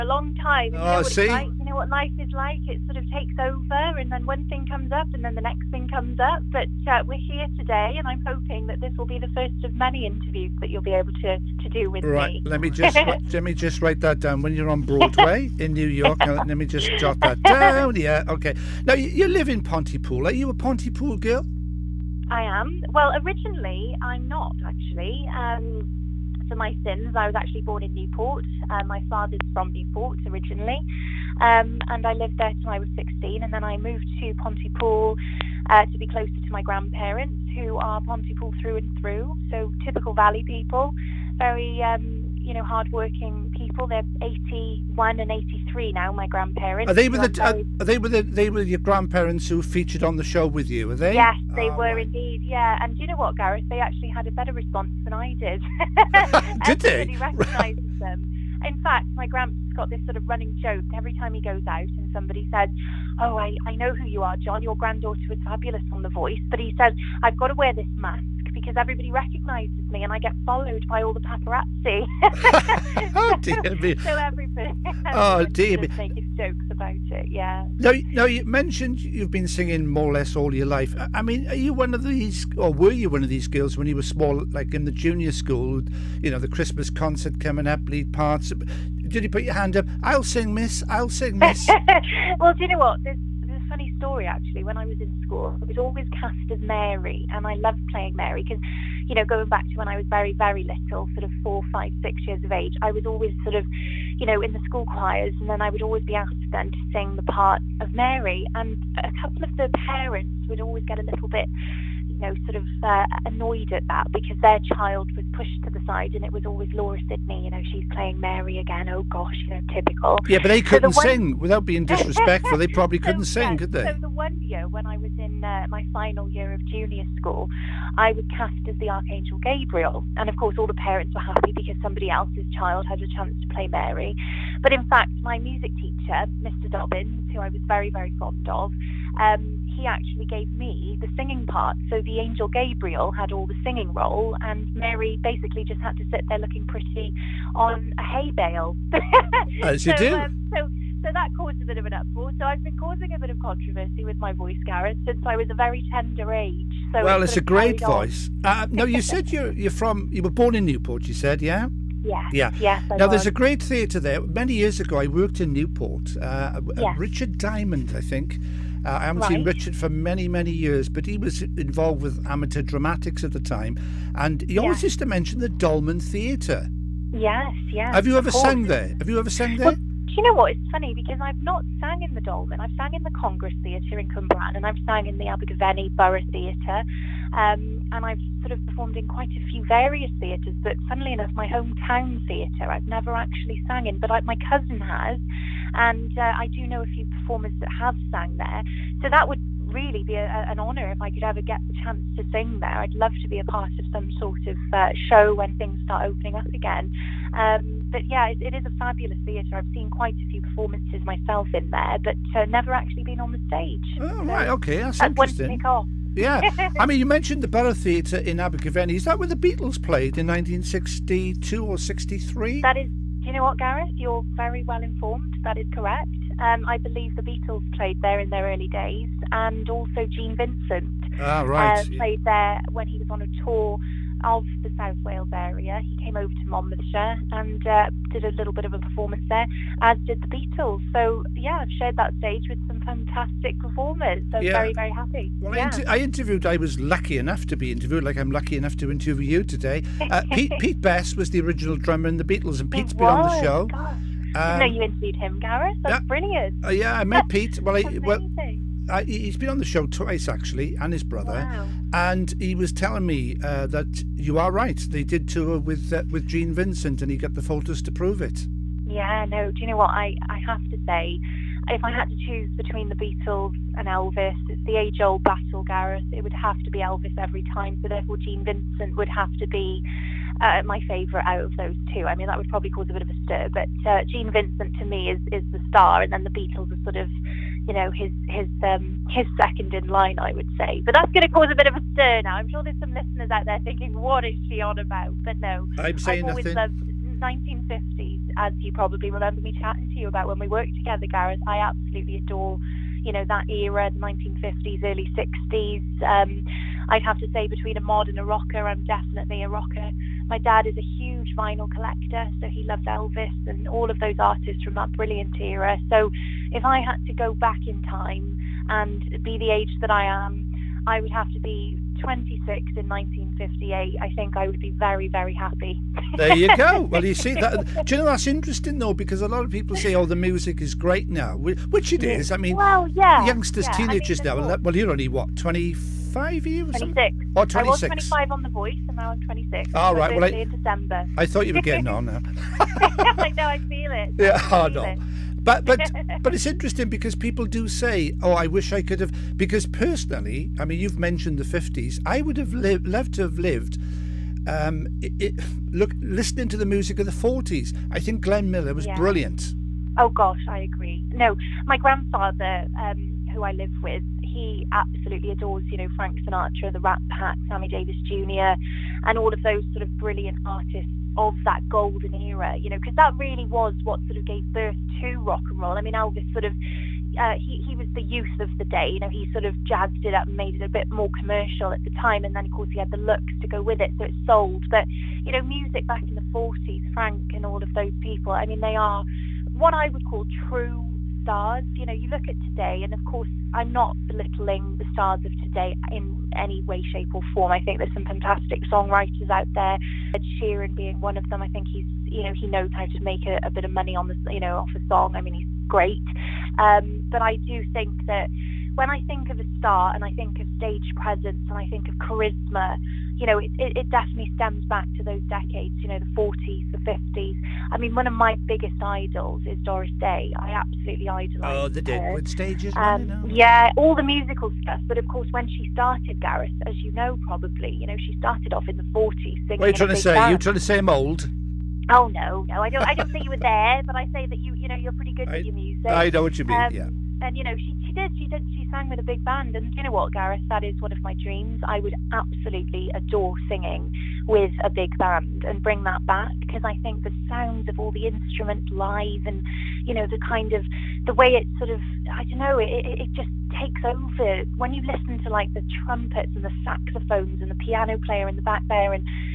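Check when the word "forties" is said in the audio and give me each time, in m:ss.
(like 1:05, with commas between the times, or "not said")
5:57.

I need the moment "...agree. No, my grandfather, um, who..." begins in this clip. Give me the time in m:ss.
6:00.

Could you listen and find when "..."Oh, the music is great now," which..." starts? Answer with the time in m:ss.
5:29.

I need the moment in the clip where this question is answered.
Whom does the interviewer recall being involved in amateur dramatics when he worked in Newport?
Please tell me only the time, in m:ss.
2:46.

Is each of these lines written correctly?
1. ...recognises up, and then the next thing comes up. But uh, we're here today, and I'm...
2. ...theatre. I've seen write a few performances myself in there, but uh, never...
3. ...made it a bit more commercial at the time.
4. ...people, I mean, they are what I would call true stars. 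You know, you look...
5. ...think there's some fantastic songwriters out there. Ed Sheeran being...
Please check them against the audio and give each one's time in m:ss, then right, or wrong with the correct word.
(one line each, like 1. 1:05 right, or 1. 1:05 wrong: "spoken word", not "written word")
1. 0:04 wrong: "comes", not "recognises"
2. 3:29 wrong: "quite", not "write"
3. 6:20 right
4. 6:27 right
5. 6:37 right.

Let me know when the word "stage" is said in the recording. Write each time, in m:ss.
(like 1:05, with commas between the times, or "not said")
3:33, 4:02, 6:50, 7:02.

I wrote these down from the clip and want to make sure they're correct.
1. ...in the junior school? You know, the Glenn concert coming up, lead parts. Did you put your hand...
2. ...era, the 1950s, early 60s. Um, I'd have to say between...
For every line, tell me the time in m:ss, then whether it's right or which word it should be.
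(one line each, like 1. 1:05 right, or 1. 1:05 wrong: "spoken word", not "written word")
1. 1:24 wrong: "Christmas", not "Glenn"
2. 5:03 right.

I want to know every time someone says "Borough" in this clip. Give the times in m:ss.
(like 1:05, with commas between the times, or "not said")
3:05, 3:37.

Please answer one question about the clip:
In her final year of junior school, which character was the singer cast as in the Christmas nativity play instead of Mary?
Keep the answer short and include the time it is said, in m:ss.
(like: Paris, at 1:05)
Archangel Gabriel, at 2:08.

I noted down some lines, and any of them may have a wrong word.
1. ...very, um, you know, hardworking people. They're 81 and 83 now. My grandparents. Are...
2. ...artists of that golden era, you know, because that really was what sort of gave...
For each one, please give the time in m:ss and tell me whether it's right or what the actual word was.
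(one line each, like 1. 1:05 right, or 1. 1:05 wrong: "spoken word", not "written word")
1. 0:41 right
2. 6:10 right.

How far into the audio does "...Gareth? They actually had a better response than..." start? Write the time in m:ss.
0:53.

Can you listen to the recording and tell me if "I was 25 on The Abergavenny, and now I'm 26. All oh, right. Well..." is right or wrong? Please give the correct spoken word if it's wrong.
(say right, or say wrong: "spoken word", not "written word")
wrong: "Voice", not "Abergavenny".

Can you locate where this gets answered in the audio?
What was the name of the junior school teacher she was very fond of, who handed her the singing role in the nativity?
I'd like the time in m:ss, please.
2:16.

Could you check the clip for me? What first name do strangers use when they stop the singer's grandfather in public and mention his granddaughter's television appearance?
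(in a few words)
John.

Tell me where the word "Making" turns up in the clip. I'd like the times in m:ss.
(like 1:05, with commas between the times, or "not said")
1:15.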